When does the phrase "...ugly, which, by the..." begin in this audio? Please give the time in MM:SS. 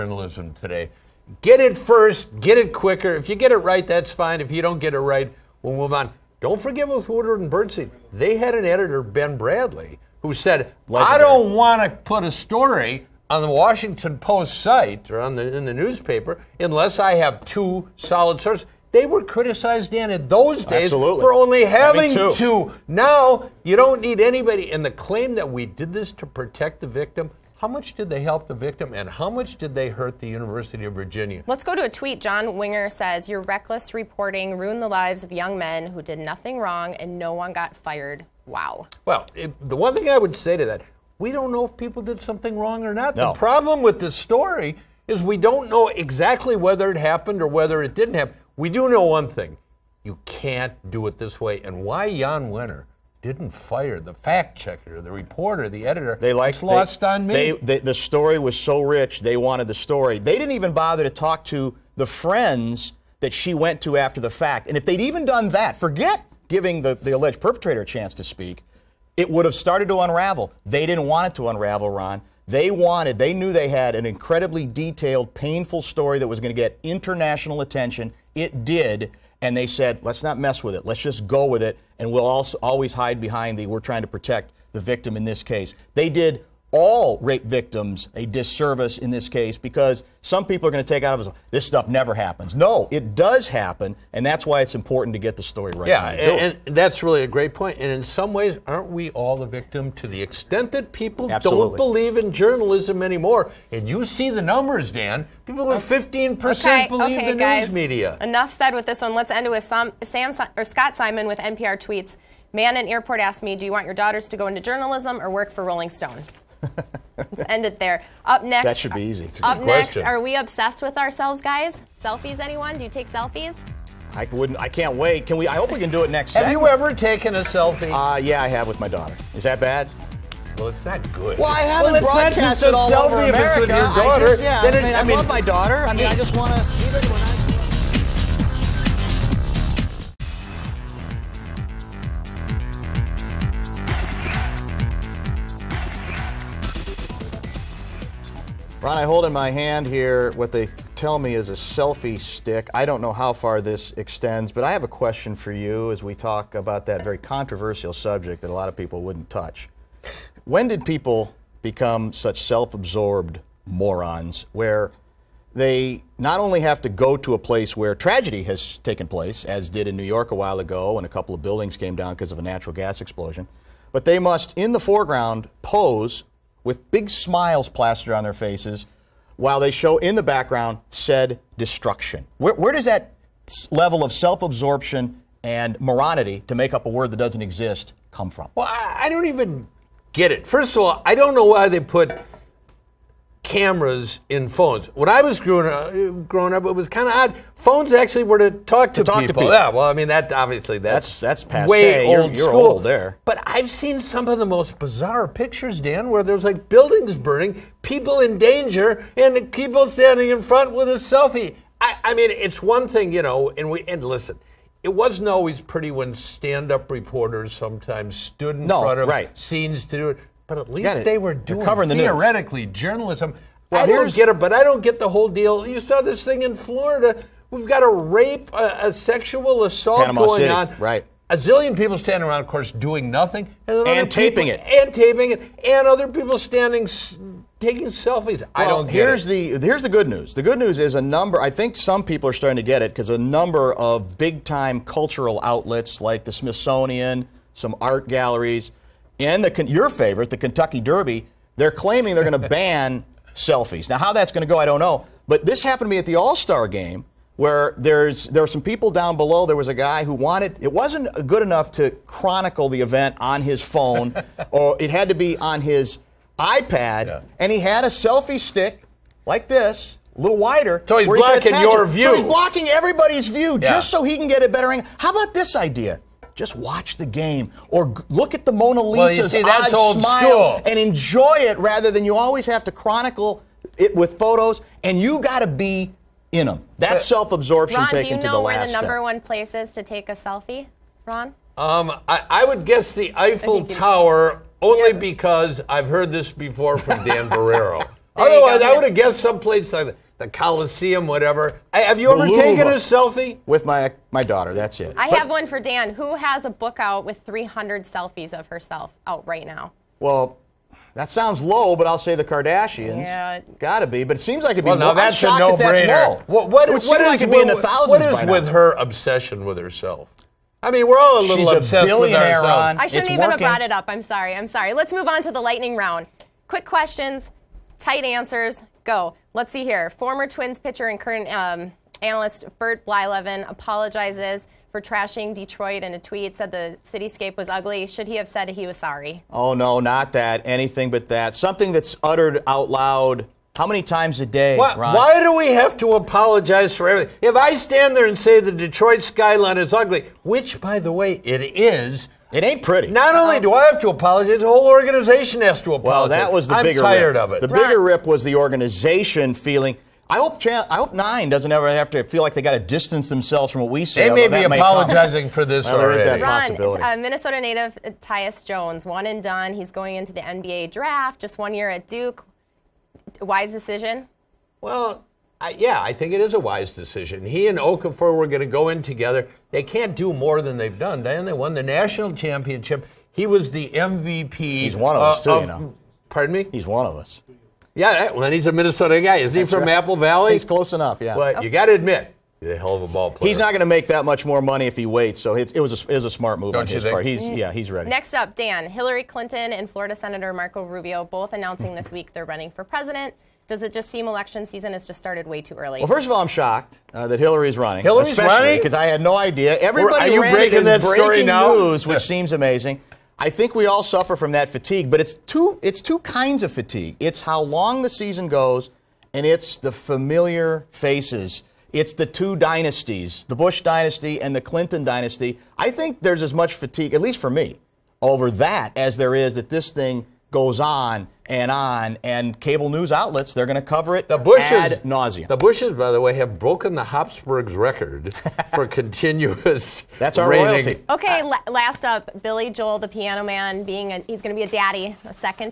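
05:49.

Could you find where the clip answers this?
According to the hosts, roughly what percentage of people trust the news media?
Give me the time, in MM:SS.
01:45.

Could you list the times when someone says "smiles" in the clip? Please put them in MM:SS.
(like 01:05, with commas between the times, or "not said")
02:57, 04:39.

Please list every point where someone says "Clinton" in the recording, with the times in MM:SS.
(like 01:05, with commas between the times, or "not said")
06:39, 07:04.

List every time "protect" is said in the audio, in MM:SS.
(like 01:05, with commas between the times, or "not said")
00:26, 01:24.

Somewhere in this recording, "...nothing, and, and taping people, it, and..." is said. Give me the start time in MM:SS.
03:53.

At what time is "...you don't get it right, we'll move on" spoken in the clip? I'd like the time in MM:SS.
00:04.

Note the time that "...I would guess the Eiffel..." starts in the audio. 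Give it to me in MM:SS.
04:52.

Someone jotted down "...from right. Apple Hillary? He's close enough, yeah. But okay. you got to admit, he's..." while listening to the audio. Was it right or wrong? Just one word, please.
wrong.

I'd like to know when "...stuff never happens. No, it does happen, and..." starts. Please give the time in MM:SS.
01:31.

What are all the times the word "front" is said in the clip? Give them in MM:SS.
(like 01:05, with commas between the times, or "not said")
03:30, 03:38.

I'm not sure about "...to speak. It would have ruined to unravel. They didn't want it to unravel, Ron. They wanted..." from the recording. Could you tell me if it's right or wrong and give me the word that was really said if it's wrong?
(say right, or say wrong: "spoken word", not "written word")
wrong: "started", not "ruined".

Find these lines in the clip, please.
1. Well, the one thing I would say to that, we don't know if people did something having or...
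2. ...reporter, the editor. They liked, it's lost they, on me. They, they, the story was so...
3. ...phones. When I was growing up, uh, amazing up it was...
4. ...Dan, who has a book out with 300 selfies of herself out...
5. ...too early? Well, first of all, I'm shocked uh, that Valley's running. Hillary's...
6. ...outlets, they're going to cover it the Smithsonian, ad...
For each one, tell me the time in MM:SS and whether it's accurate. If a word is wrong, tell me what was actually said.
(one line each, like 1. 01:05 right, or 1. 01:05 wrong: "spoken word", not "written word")
1. 00:39 wrong: "wrong", not "having"
2. 00:55 right
3. 03:14 wrong: "growing", not "amazing"
4. 05:05 right
5. 06:45 wrong: "Hillary", not "Valley"
6. 07:12 wrong: "Bushes", not "Smithsonian".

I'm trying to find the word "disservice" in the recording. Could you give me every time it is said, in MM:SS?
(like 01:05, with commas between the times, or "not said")
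01:28.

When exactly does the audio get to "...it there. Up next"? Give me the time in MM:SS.
01:57.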